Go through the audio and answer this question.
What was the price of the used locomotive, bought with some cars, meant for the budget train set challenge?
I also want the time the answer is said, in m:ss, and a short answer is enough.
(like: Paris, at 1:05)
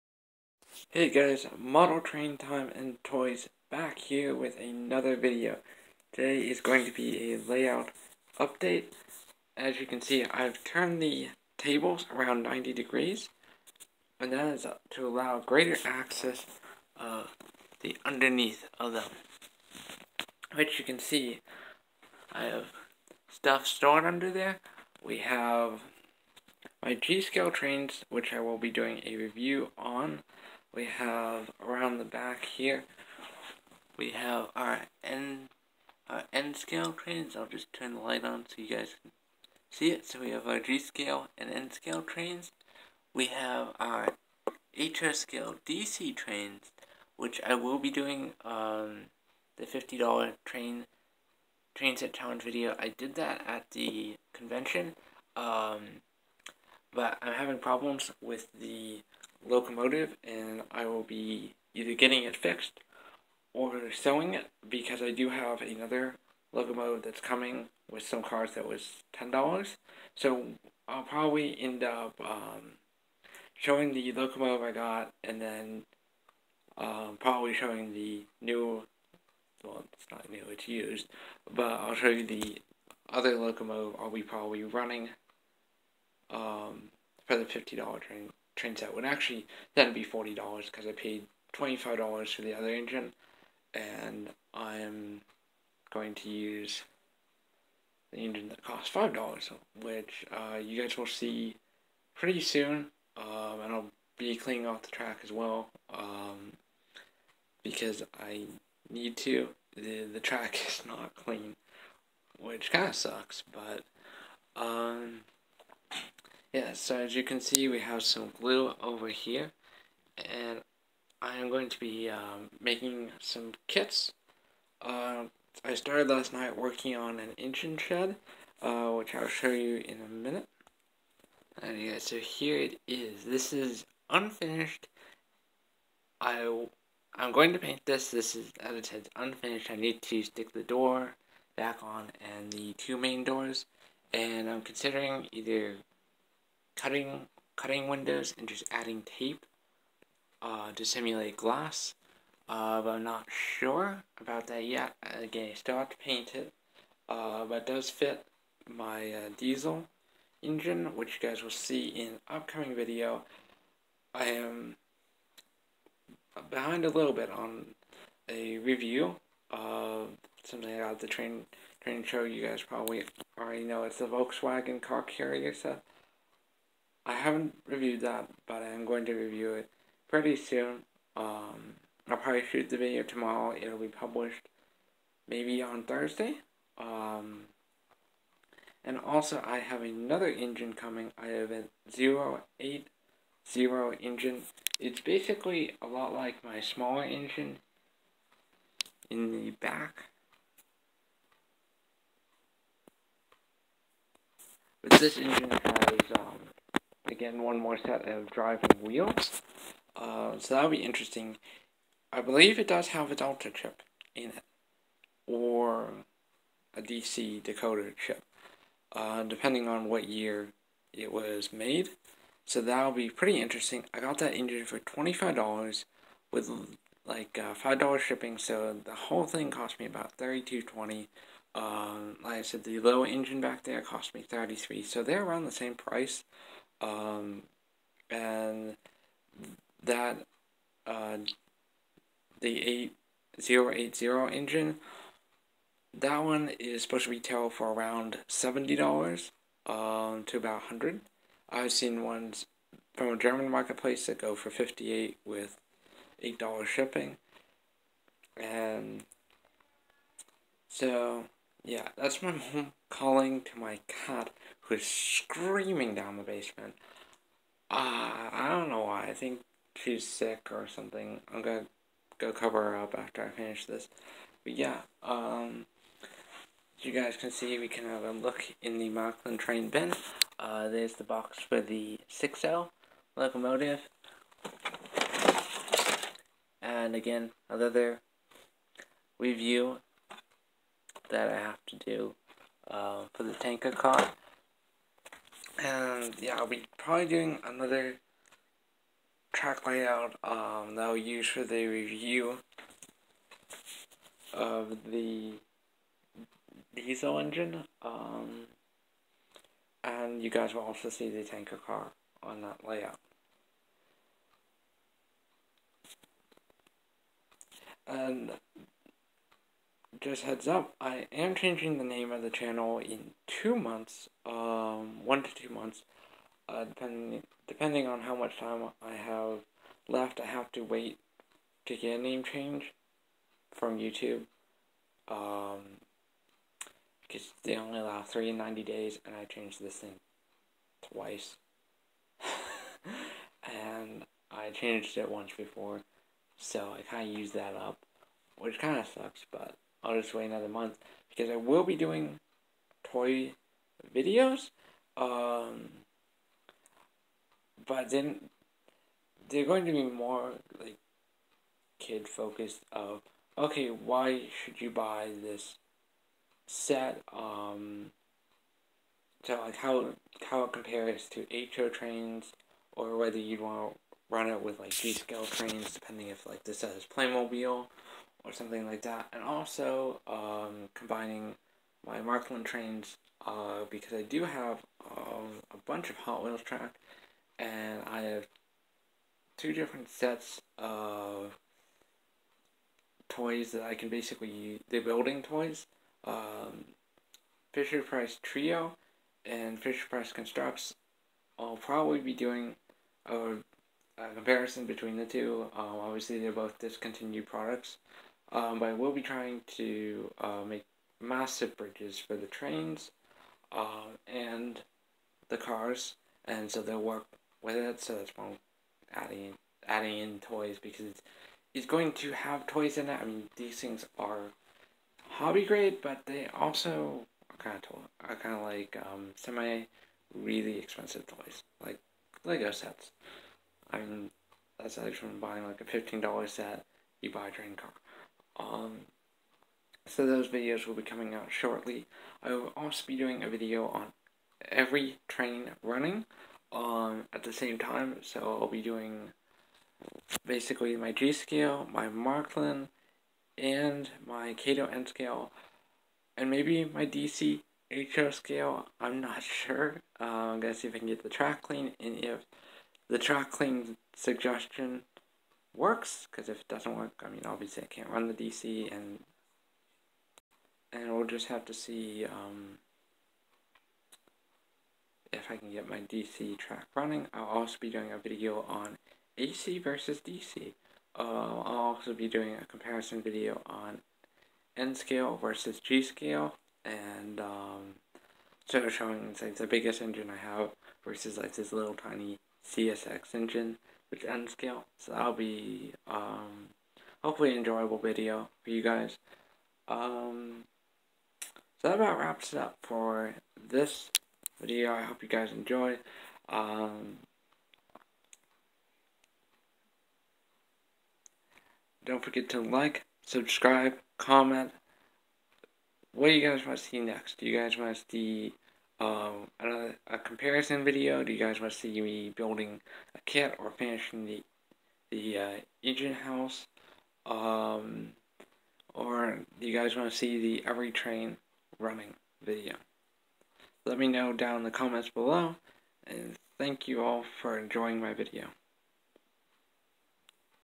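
$10, at 1:09.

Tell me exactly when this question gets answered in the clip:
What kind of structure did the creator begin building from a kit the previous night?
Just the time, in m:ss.
2:07.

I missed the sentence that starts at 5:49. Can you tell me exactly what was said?
I'll just wait another month because I will be doing toy videos.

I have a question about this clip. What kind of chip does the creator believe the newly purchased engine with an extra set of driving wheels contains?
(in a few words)
Delta chip.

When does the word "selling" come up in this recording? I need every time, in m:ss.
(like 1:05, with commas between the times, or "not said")
1:03.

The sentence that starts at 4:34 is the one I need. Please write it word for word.
But yeah, um, you guys can see, we can have a look in the Marklin train bin.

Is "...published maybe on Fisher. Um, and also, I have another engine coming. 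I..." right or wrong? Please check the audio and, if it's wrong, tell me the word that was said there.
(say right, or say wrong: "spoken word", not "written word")
wrong: "Thursday", not "Fisher".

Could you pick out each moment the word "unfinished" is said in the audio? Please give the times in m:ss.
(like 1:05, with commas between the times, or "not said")
2:14, 2:19.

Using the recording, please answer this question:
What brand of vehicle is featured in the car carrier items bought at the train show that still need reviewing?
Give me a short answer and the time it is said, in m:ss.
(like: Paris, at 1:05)
Volkswagen, at 2:54.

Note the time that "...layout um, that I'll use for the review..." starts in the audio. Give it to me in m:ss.
4:59.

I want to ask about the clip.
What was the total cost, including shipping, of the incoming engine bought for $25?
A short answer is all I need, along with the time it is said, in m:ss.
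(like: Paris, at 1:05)
$32.20, at 3:50.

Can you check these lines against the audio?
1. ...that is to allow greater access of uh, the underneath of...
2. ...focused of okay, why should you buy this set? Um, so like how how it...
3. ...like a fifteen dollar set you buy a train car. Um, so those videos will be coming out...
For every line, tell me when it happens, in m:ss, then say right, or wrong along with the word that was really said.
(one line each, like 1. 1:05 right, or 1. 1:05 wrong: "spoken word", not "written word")
1. 0:14 right
2. 6:02 right
3. 7:15 right.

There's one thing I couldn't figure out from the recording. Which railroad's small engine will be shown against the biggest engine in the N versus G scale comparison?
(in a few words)
CSX.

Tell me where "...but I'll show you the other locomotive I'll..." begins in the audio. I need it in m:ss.
1:21.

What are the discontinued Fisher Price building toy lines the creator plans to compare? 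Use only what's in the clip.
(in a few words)
Fisher Price Trio.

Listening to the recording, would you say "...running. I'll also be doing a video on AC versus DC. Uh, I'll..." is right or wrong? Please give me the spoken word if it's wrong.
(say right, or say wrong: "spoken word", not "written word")
right.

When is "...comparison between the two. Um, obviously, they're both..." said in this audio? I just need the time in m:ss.
6:44.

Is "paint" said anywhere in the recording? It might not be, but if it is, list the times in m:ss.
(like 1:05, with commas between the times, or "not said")
2:17, 2:35.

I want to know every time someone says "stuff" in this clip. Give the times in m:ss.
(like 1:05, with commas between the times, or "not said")
0:23, 2:55.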